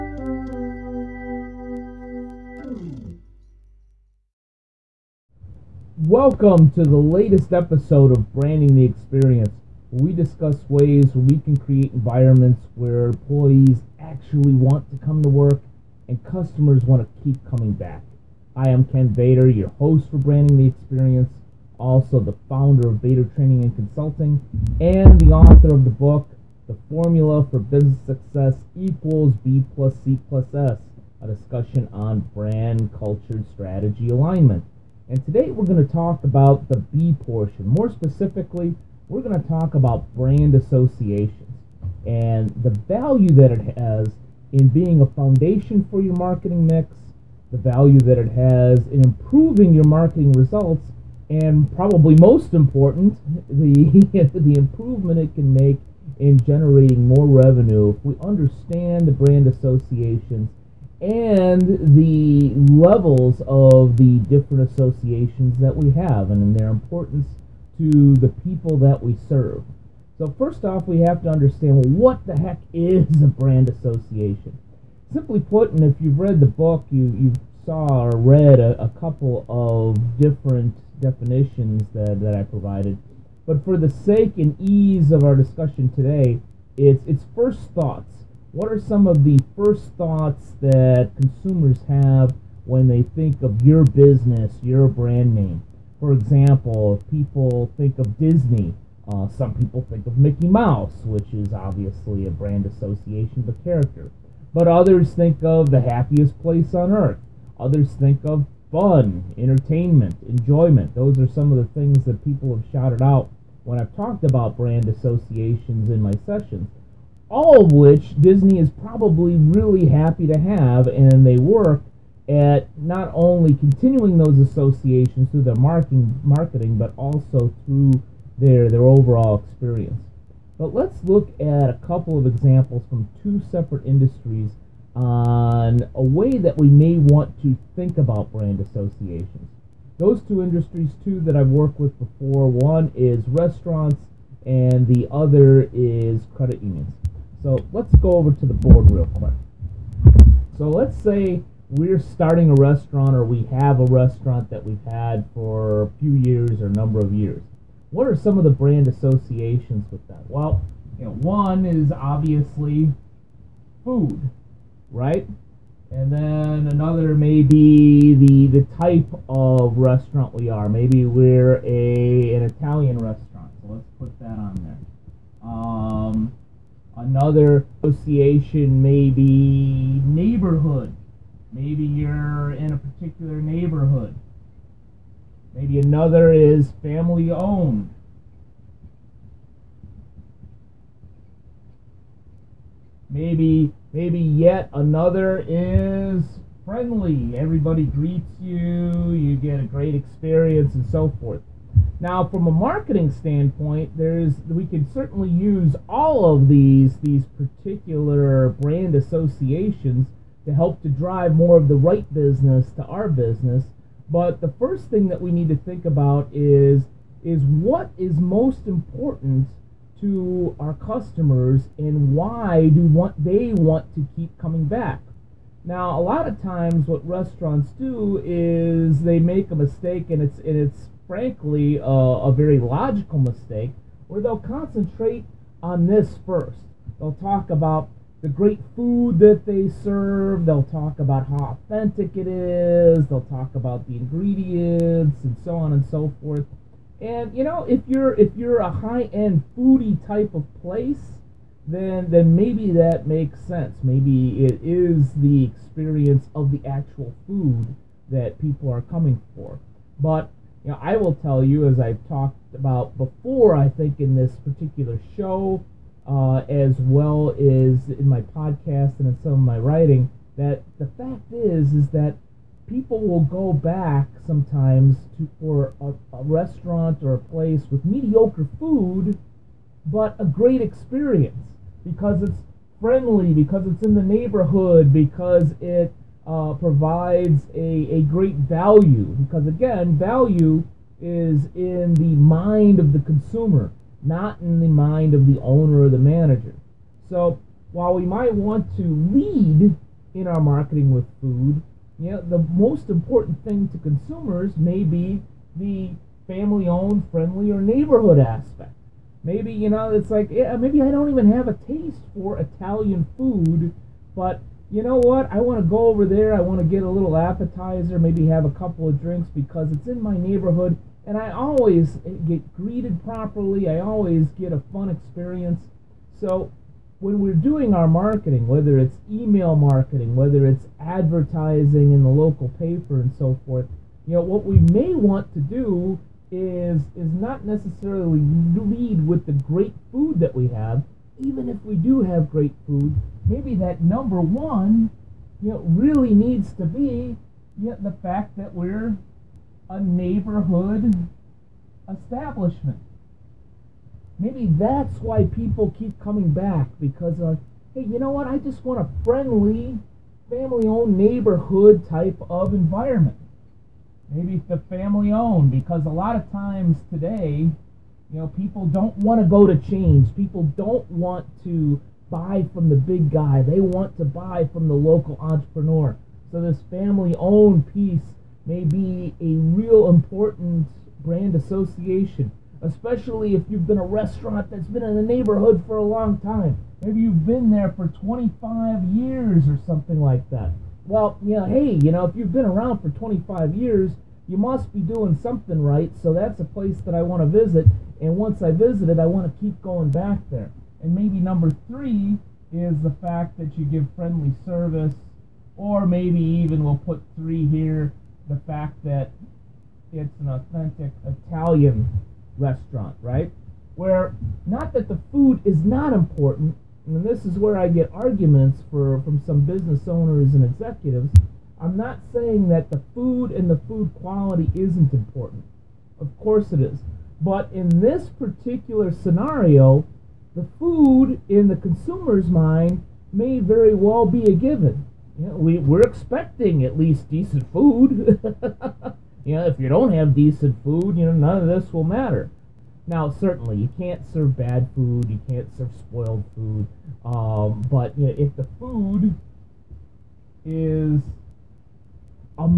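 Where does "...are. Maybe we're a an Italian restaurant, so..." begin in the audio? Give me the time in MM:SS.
02:50.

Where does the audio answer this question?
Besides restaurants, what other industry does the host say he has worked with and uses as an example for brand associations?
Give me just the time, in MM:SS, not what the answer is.
02:26.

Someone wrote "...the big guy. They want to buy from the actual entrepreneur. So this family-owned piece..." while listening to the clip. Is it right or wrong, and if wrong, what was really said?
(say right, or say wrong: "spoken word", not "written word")
wrong: "local", not "actual".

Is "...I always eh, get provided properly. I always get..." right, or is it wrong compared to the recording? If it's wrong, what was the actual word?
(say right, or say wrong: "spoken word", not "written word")
wrong: "greeted", not "provided".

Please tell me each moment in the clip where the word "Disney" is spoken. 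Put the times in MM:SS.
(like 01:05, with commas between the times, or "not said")
01:38, 01:58.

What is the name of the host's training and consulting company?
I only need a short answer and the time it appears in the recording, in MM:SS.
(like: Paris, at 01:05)
Bator Training and Consulting, at 00:22.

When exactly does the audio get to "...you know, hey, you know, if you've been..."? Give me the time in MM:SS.
06:31.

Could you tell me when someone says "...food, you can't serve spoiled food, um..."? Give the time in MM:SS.
07:24.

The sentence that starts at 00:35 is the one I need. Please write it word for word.
And today we're going to talk about the B portion.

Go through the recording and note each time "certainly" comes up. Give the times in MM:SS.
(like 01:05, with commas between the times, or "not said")
03:24, 07:23.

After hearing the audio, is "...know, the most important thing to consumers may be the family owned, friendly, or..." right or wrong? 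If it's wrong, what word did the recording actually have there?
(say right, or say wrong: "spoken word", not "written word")
right.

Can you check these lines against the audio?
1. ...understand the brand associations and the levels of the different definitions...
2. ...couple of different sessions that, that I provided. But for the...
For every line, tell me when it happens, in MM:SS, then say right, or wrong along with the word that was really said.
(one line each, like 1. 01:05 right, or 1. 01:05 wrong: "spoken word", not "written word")
1. 00:58 wrong: "associations", not "definitions"
2. 01:18 wrong: "definitions", not "sessions".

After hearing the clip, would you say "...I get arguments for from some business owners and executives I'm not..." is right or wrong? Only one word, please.
right.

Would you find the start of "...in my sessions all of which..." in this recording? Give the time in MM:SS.
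01:55.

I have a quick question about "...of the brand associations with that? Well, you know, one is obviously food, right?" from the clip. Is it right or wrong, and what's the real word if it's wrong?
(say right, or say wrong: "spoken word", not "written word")
right.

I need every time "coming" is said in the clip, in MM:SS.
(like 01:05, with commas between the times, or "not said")
00:17, 03:44, 04:18, 05:55.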